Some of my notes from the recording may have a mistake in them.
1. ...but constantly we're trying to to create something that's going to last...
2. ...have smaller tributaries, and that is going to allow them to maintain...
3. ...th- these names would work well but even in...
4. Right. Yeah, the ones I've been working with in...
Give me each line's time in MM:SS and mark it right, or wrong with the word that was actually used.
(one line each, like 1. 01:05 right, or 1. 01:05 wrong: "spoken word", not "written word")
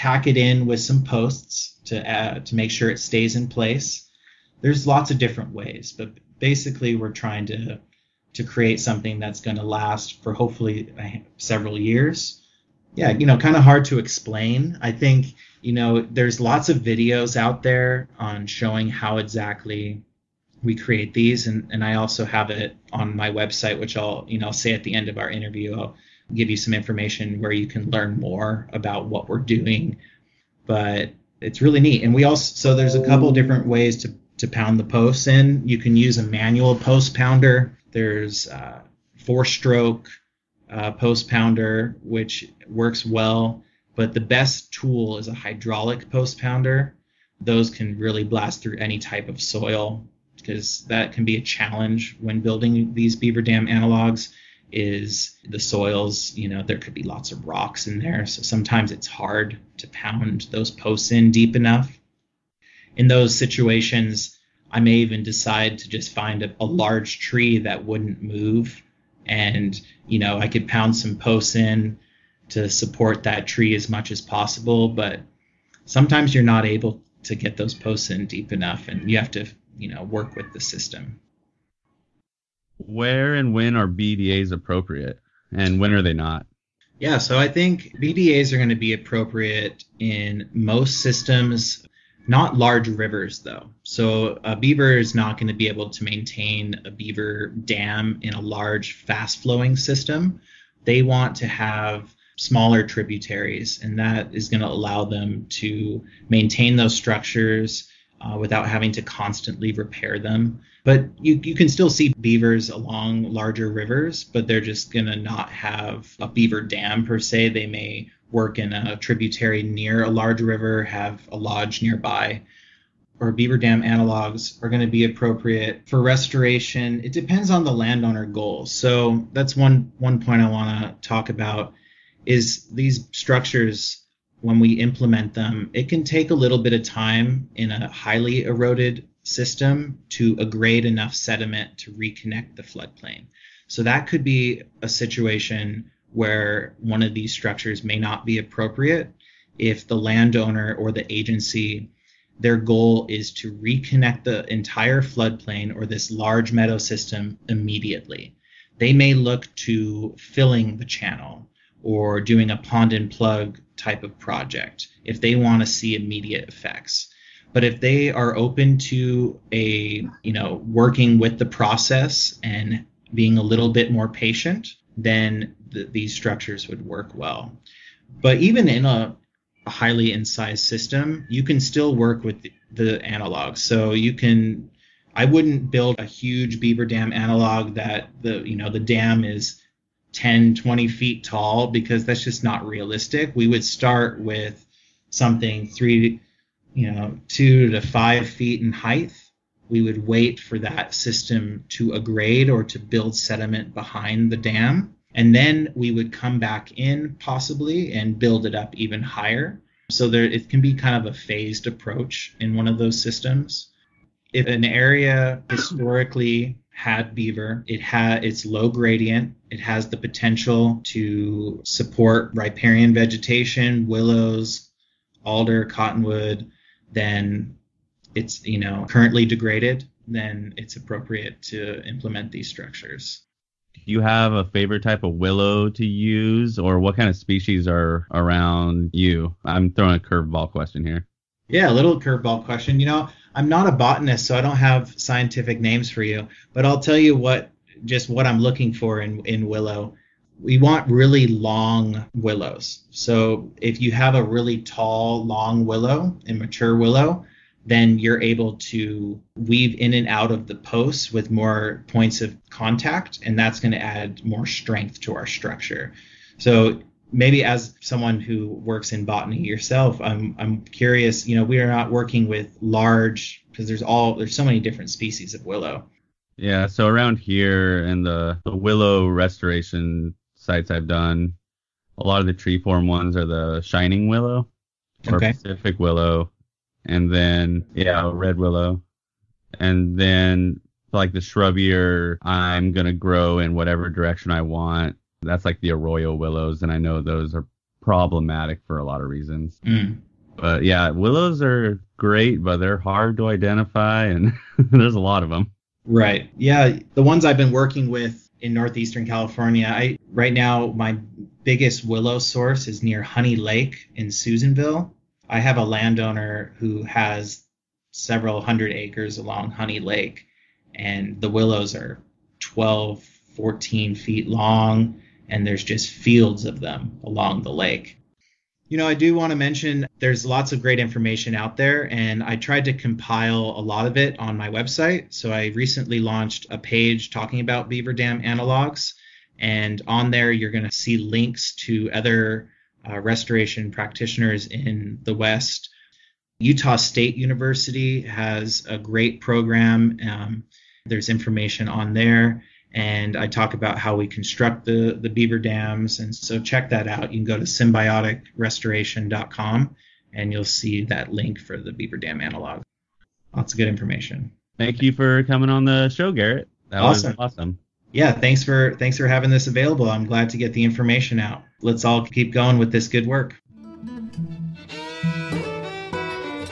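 1. 00:05 wrong: "basically", not "constantly"
2. 01:41 right
3. 02:55 wrong: "structures", not "names"
4. 05:05 right.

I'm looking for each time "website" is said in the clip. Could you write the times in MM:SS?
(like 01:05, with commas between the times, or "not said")
00:23, 05:34.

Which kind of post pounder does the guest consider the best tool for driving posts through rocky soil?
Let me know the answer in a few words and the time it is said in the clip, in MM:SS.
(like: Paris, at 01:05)
Hydraulic post pounder, at 00:45.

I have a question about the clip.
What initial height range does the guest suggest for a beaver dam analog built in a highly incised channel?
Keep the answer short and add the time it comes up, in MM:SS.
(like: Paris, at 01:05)
2 to 5 feet, at 03:17.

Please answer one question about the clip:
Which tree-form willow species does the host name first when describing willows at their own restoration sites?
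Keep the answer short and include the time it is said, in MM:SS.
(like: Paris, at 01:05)
Shining willow, at 04:43.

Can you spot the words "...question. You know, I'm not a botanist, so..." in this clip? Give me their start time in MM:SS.
04:02.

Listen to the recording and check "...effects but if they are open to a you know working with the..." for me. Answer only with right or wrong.
right.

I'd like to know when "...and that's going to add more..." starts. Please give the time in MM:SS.
04:23.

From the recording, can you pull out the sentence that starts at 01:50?
But you, you can still see beavers along larger rivers, but they're just going to not have a beaver dam per se.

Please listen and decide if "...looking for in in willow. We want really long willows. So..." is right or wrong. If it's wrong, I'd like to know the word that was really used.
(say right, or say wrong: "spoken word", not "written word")
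right.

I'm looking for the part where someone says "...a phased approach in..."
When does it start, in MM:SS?
03:31.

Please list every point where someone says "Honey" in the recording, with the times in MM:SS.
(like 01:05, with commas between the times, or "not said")
05:13, 05:19.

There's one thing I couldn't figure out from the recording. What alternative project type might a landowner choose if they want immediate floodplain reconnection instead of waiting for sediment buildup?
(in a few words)
Pond and plug.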